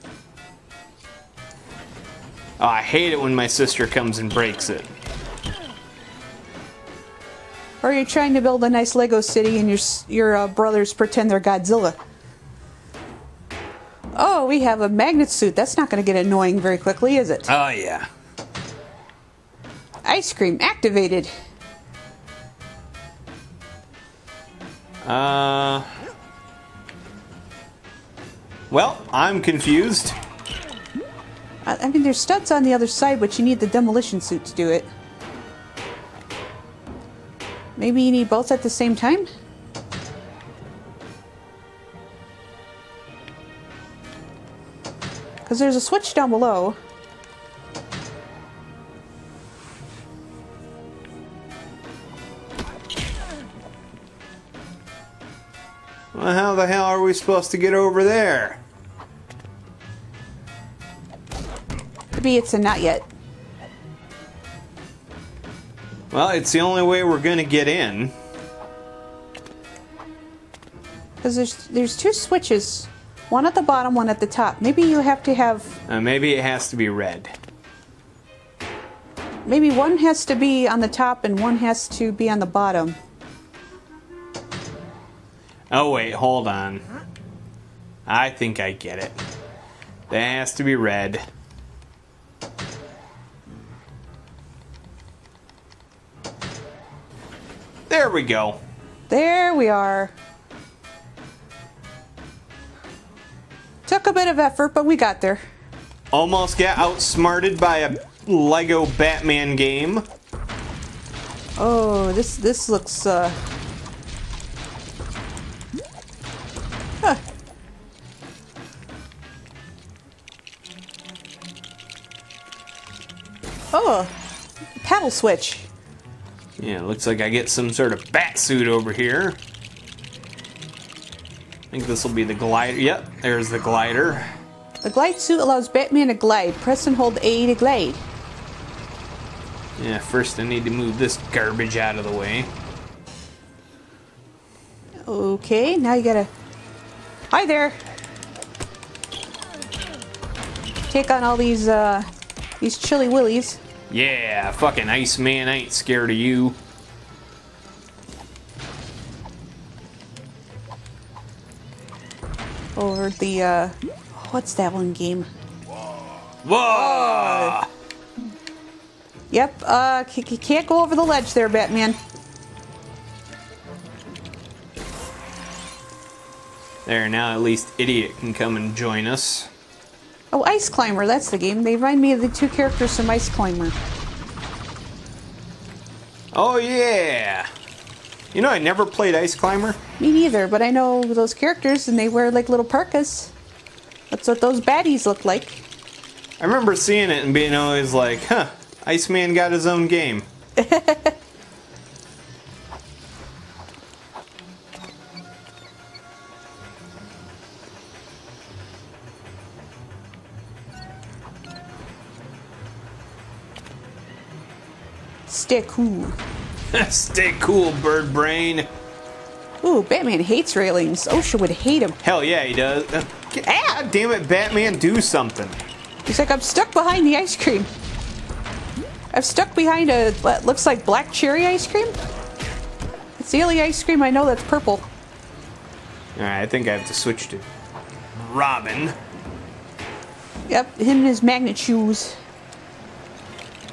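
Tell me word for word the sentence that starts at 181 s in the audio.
They remind me of the two characters from Ice Climber.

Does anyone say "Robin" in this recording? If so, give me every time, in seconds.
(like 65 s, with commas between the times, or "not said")
238 s.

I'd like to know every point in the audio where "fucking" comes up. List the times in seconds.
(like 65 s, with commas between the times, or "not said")
154 s.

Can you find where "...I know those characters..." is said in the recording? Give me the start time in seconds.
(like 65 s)
190 s.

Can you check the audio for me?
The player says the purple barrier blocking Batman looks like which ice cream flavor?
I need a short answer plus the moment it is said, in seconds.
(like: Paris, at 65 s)
Black cherry, at 230 s.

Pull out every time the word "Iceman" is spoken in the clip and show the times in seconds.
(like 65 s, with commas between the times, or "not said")
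154 s, 198 s.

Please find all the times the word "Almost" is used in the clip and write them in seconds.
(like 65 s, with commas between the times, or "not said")
106 s.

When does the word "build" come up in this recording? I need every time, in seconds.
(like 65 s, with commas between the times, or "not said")
8 s.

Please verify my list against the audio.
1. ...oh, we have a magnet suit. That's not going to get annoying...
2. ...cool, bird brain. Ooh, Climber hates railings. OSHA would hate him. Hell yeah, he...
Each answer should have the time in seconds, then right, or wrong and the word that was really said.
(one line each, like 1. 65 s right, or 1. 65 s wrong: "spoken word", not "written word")
1. 14 s right
2. 217 s wrong: "Batman", not "Climber".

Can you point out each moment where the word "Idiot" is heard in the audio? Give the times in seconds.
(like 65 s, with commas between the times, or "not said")
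177 s.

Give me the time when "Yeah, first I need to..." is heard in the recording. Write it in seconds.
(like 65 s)
139 s.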